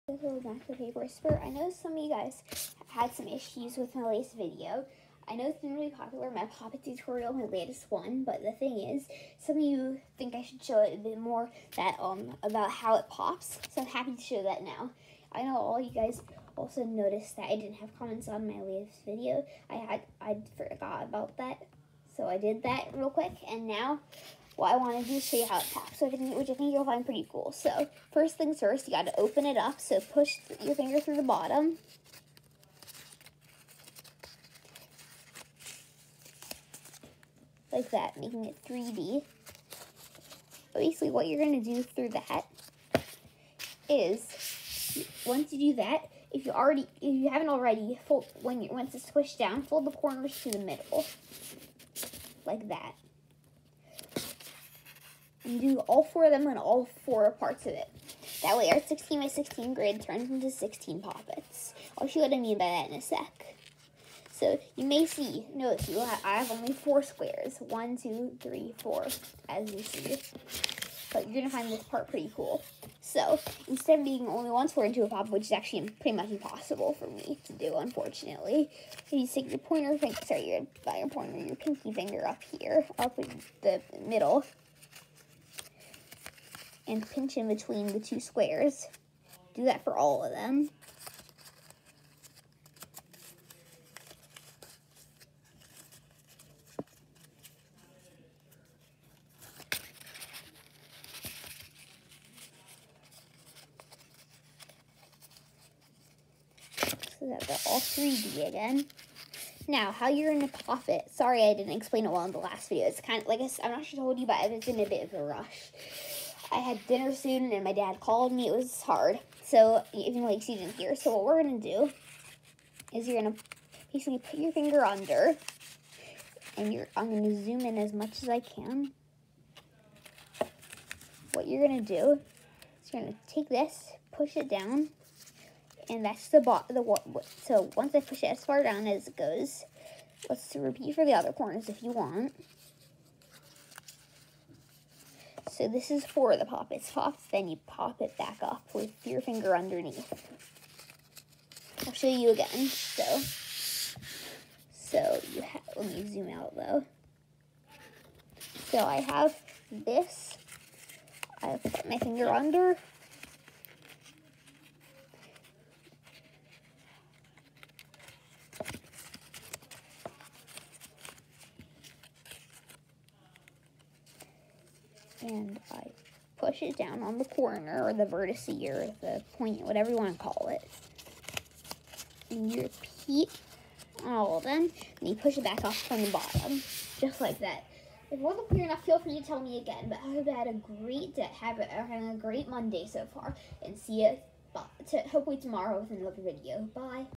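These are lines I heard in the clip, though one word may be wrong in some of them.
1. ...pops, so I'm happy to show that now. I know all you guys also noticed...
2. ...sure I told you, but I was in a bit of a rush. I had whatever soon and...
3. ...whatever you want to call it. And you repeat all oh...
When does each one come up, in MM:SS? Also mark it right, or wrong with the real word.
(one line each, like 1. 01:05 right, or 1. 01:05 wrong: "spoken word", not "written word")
1. 00:13 right
2. 01:53 wrong: "dinner", not "whatever"
3. 02:59 right.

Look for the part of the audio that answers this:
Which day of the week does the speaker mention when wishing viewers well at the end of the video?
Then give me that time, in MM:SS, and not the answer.
03:12.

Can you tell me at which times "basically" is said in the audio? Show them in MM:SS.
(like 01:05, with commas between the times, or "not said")
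00:40, 02:03.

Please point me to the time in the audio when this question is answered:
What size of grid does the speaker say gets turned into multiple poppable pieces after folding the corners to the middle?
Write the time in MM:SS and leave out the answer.
00:58.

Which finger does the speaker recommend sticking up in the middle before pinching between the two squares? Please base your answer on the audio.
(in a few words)
pinky finger.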